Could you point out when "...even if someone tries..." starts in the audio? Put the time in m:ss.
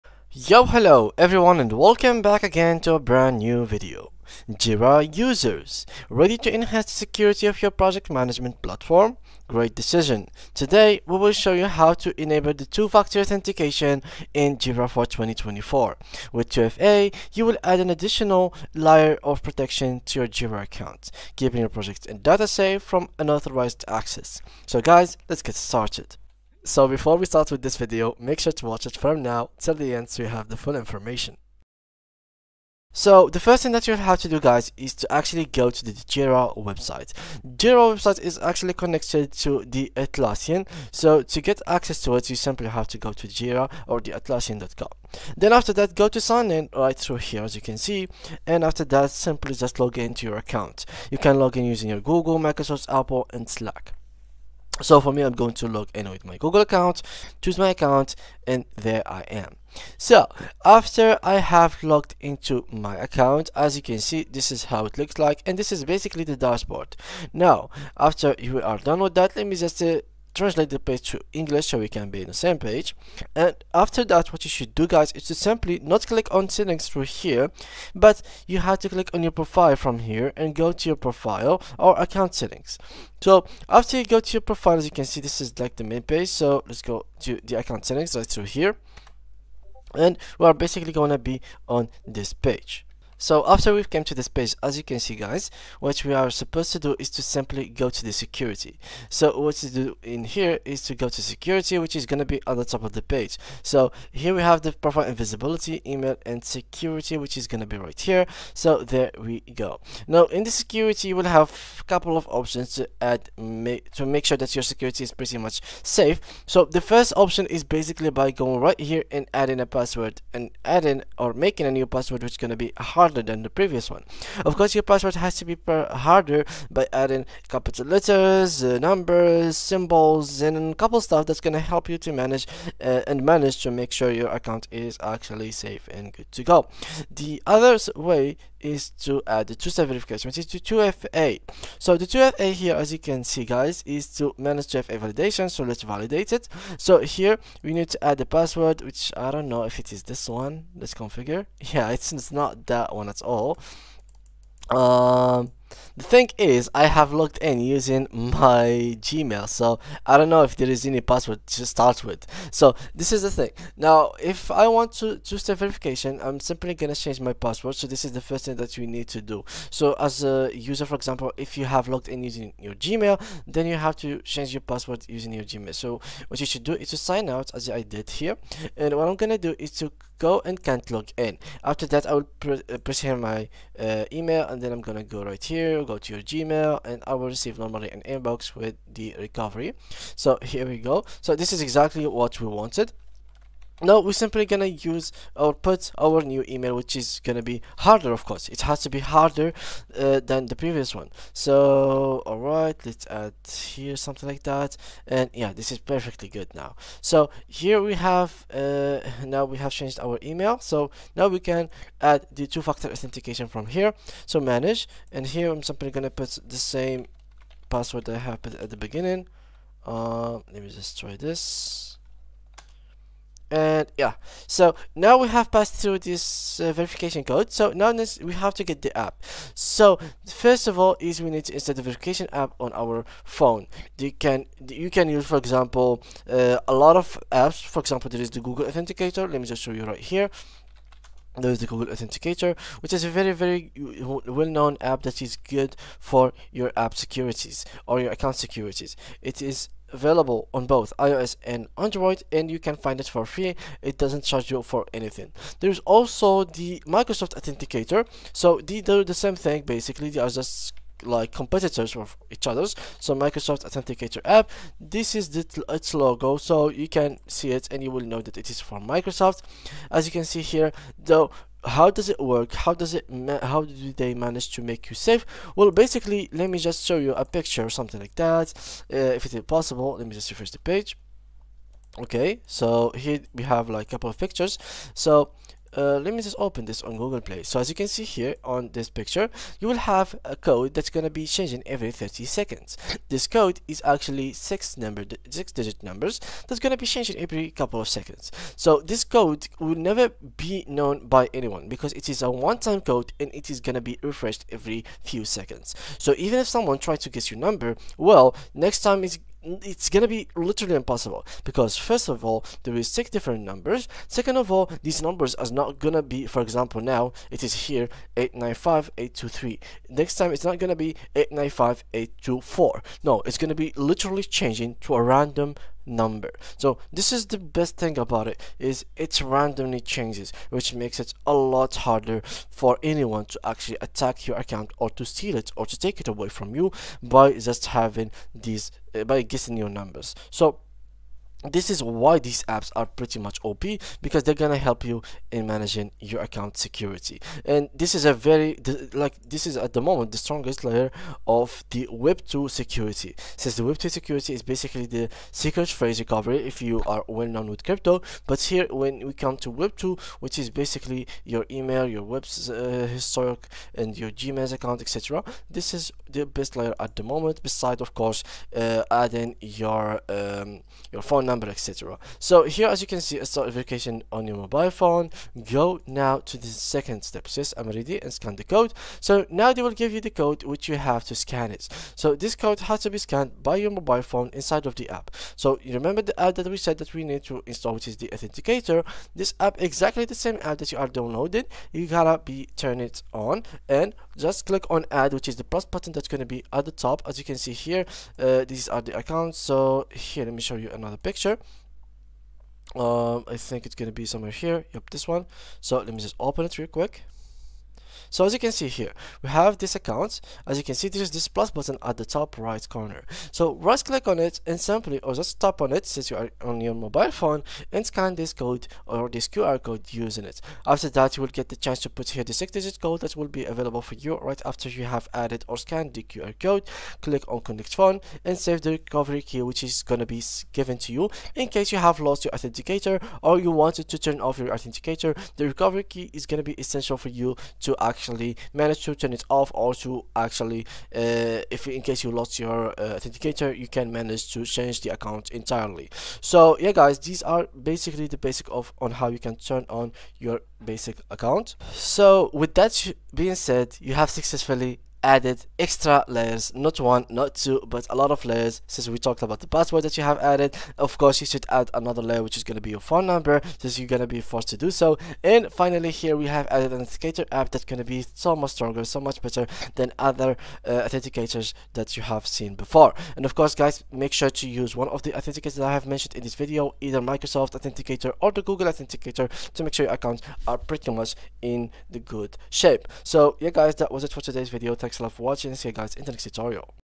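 5:06.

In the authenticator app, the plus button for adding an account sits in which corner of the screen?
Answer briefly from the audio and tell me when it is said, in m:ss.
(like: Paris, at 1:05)
top right corner, at 6:52.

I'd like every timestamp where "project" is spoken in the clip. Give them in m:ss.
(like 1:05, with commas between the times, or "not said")
0:07, 0:21.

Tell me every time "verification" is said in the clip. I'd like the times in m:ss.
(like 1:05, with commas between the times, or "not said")
2:19, 2:45, 3:46, 3:51, 6:13.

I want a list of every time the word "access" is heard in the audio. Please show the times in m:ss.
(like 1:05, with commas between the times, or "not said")
0:23, 0:41.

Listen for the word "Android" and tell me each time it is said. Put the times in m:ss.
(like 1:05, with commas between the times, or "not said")
4:11.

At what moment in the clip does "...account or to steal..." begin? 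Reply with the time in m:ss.
5:34.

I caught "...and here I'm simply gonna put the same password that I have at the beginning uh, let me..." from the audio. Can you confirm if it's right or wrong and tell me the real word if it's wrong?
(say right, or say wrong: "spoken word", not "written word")
right.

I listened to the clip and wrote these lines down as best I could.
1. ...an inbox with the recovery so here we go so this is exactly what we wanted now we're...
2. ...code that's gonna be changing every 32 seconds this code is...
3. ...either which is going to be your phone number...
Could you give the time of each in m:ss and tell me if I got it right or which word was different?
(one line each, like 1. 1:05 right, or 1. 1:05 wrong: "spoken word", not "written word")
1. 3:07 right
2. 4:50 wrong: "30", not "32"
3. 7:42 wrong: "layer", not "either".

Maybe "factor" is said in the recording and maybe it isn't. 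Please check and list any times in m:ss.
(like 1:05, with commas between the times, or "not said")
0:12, 3:32.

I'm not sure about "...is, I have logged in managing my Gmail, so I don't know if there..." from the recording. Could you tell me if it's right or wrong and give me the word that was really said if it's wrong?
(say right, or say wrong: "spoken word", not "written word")
wrong: "using", not "managing".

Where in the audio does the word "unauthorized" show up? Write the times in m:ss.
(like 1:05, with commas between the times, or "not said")
0:23.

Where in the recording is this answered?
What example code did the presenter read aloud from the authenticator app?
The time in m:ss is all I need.
5:18.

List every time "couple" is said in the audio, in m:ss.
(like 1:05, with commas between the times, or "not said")
1:51, 2:10, 4:43, 4:57.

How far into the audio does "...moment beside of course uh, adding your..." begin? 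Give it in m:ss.
6:07.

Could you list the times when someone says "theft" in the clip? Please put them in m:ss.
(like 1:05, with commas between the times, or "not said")
not said.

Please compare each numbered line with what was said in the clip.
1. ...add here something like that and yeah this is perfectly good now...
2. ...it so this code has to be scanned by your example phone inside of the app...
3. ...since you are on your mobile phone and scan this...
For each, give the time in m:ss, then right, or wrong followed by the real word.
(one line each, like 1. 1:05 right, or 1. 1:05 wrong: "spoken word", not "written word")
1. 3:23 right
2. 6:21 wrong: "mobile", not "example"
3. 6:55 right.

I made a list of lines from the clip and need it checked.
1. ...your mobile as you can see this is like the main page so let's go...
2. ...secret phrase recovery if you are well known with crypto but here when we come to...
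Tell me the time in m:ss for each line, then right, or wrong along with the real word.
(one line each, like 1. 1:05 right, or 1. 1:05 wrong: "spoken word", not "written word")
1. 1:24 wrong: "profile", not "mobile"
2. 5:55 right.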